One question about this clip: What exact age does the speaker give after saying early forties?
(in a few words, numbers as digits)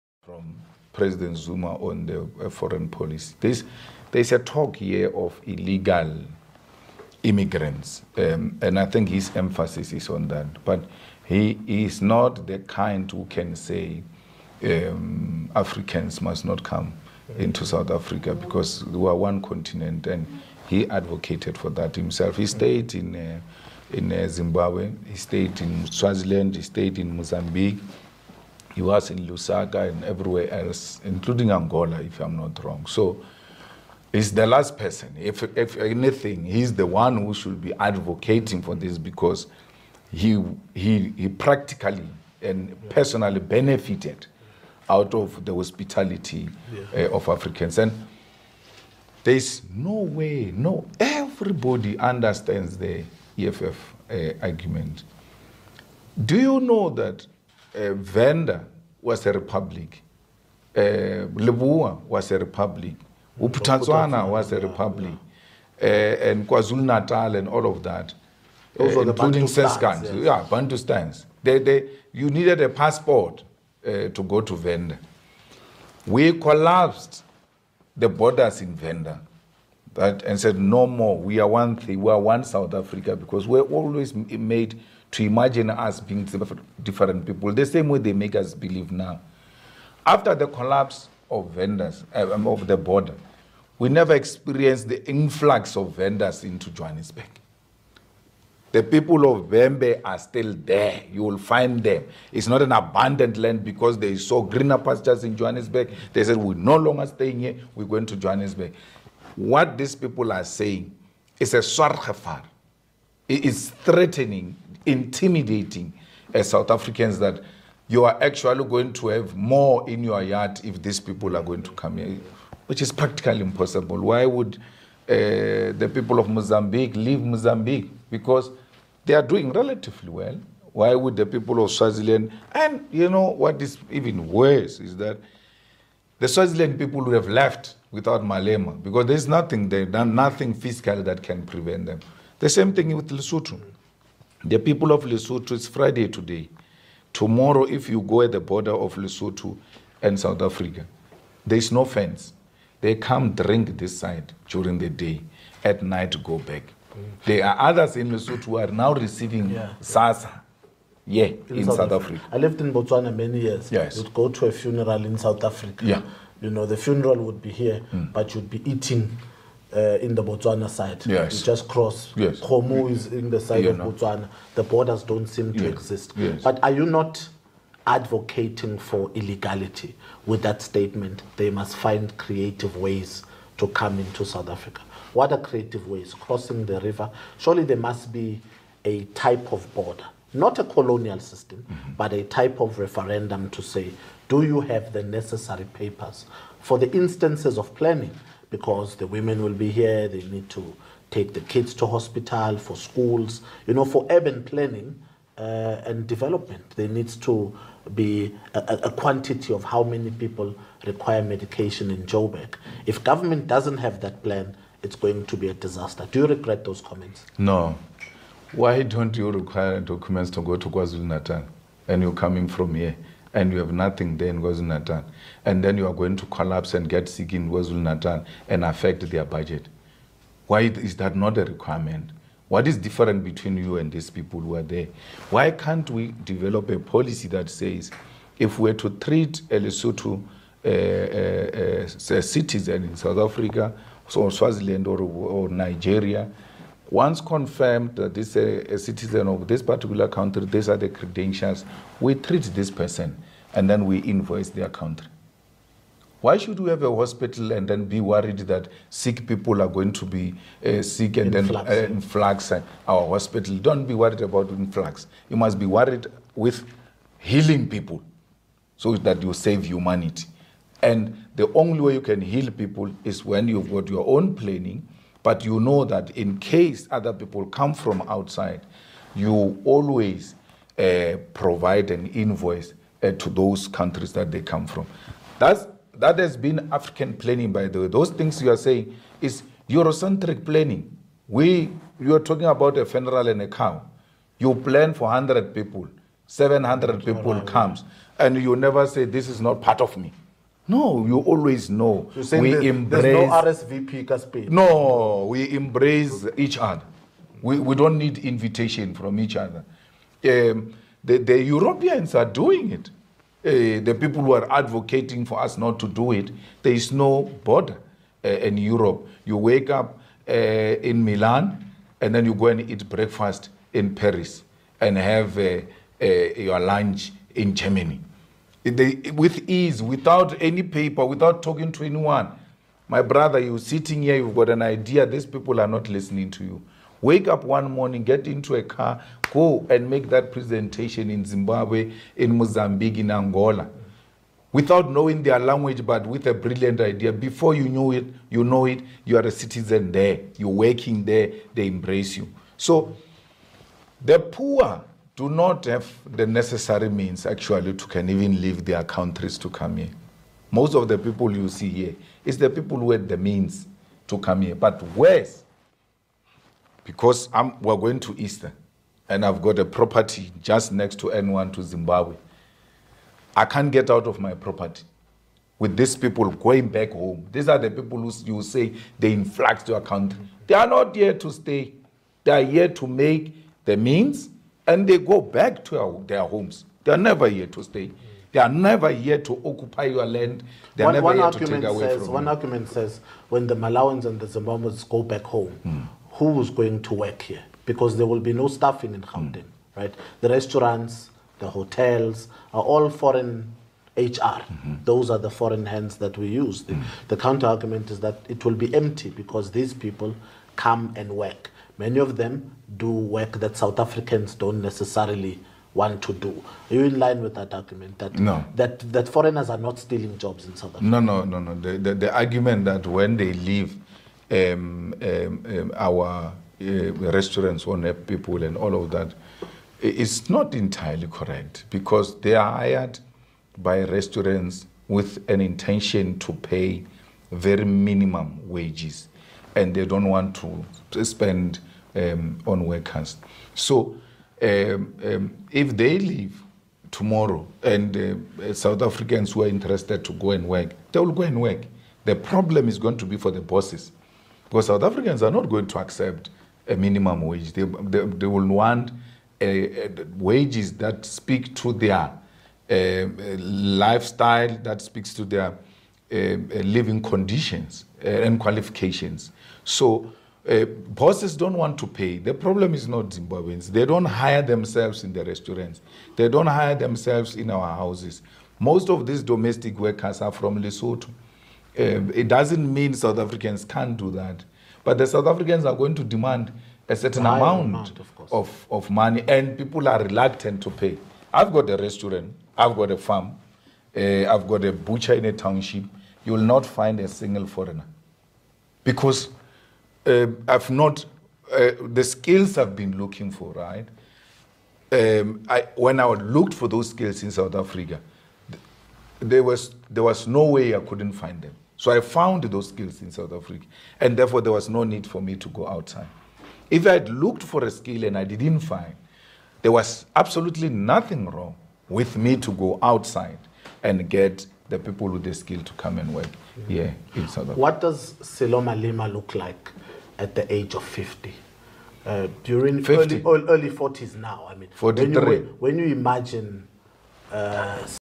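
43.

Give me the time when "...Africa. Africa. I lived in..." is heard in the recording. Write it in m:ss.
2:41.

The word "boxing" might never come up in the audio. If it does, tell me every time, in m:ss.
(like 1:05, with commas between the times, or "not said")
not said.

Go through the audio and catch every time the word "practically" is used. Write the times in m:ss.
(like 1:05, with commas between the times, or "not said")
0:41, 2:02.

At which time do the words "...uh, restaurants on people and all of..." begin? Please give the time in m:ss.
7:06.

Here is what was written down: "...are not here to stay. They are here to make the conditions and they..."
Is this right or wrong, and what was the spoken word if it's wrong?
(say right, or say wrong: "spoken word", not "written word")
wrong: "means", not "conditions".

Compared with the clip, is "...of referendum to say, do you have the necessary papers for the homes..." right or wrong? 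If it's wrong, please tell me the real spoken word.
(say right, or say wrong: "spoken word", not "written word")
wrong: "instances", not "homes".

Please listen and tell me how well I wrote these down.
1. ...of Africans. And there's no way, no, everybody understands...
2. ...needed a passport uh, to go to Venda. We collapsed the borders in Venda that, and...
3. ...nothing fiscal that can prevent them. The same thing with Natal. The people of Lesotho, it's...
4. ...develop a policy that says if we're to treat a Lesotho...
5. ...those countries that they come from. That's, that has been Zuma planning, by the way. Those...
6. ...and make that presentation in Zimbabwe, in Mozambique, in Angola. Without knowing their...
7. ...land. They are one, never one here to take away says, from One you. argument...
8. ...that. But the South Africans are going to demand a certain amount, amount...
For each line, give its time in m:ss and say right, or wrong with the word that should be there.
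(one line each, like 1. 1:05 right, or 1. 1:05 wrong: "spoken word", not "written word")
1. 0:47 right
2. 1:12 right
3. 2:20 wrong: "Lesotho", not "Natal"
4. 3:56 right
5. 4:43 wrong: "African", not "Zuma"
6. 5:39 right
7. 6:30 right
8. 8:04 right.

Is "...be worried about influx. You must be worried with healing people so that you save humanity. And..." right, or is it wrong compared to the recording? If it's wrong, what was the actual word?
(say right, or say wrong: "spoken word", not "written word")
right.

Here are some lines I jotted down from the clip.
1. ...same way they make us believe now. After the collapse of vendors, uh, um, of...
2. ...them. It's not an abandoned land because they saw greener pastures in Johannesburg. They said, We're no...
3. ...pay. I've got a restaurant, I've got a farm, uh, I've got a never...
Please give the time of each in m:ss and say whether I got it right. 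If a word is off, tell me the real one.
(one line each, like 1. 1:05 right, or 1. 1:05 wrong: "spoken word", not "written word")
1. 1:27 right
2. 1:41 right
3. 8:10 wrong: "butcher", not "never".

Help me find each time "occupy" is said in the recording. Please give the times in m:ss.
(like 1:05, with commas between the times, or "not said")
6:29.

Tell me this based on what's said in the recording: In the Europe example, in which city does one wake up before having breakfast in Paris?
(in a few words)
Milan.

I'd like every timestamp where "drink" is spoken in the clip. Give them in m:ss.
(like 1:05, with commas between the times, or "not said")
2:33.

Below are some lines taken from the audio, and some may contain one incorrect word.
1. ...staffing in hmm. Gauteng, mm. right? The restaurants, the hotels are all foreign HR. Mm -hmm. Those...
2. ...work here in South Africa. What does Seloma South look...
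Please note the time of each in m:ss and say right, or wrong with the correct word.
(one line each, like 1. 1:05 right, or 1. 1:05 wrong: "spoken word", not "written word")
1. 6:38 right
2. 8:46 wrong: "Lima", not "South".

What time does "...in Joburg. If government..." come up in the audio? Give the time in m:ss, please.
3:31.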